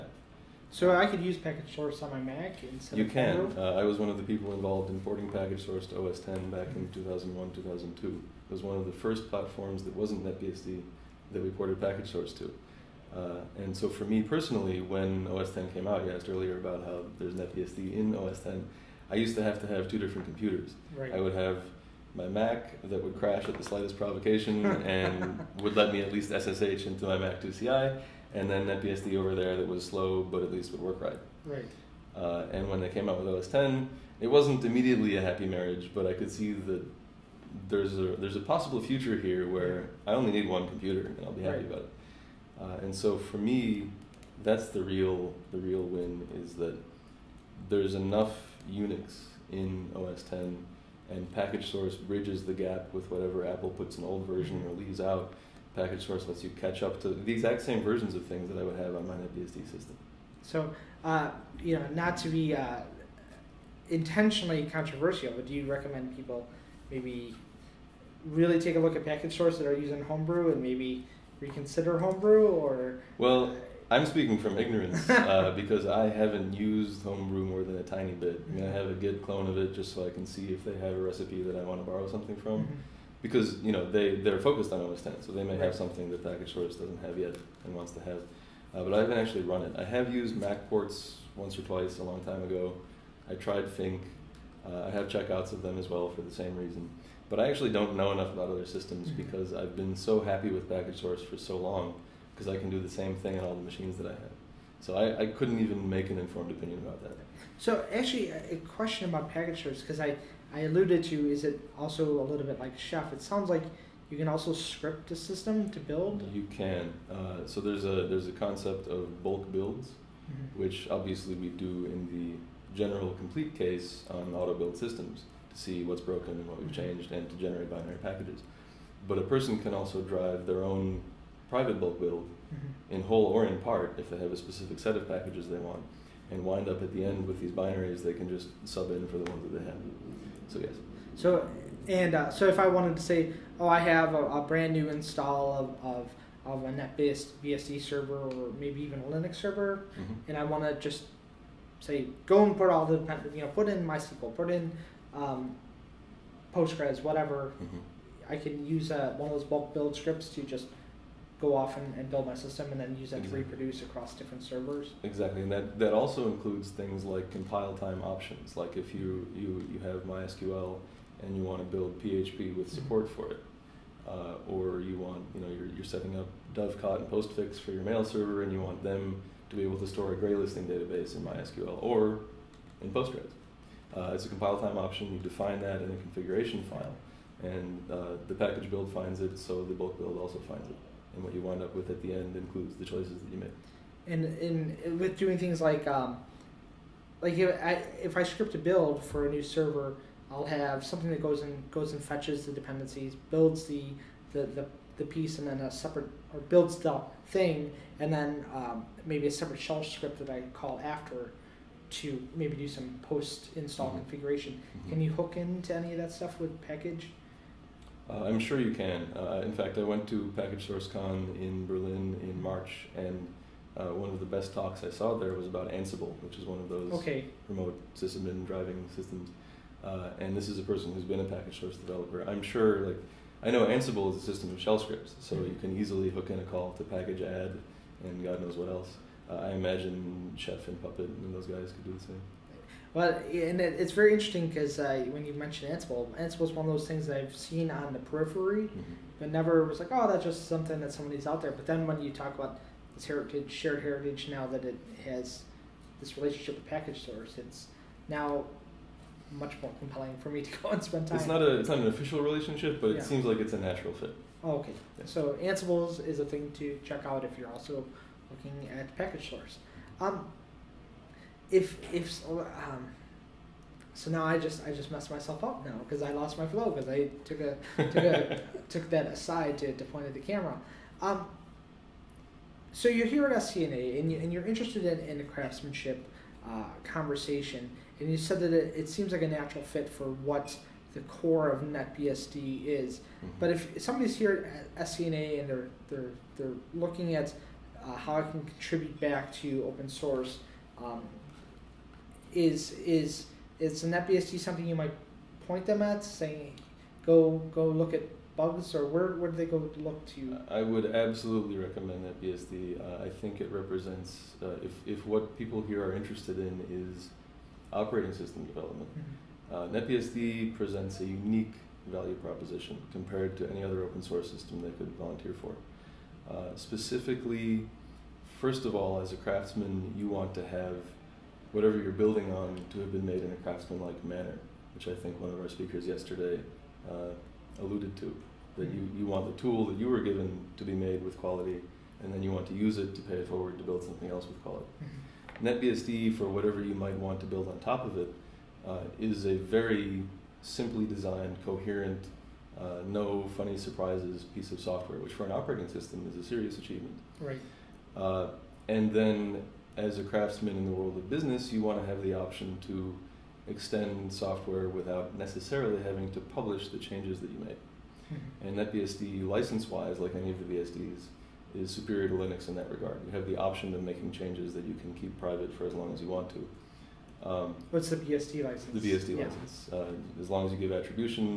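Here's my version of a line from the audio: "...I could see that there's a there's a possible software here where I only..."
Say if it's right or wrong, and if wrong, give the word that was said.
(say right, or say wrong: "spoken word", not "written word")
wrong: "future", not "software".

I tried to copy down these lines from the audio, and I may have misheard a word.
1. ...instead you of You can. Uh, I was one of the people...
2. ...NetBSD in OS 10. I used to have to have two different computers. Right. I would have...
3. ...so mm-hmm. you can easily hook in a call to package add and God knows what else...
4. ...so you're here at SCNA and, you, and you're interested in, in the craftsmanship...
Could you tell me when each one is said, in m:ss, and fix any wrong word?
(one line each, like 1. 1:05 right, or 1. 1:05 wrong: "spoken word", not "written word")
1. 0:02 right
2. 0:17 right
3. 3:55 right
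4. 4:42 right.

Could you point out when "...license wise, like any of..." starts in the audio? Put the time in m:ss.
6:09.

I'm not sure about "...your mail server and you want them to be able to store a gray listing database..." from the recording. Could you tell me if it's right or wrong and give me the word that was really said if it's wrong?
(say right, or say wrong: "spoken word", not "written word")
right.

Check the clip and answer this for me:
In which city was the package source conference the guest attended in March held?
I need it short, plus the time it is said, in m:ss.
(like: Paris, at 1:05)
Berlin, at 3:41.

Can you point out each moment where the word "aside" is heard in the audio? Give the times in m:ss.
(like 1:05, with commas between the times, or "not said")
4:39.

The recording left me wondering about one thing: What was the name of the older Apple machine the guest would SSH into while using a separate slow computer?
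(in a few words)
Mac 2CI.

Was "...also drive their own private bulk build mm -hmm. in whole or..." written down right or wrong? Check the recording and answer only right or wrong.
right.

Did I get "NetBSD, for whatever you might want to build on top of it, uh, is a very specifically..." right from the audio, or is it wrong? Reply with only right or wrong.
wrong.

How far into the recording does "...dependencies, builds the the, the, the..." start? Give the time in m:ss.
3:22.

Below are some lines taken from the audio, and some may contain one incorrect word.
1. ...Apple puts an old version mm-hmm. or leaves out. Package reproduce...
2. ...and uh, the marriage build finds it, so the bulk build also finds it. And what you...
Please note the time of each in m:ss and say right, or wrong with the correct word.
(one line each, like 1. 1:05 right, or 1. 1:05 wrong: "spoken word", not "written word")
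1. 0:53 wrong: "source", not "reproduce"
2. 3:07 wrong: "package", not "marriage".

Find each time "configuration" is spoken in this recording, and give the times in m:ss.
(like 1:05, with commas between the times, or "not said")
3:05, 3:33.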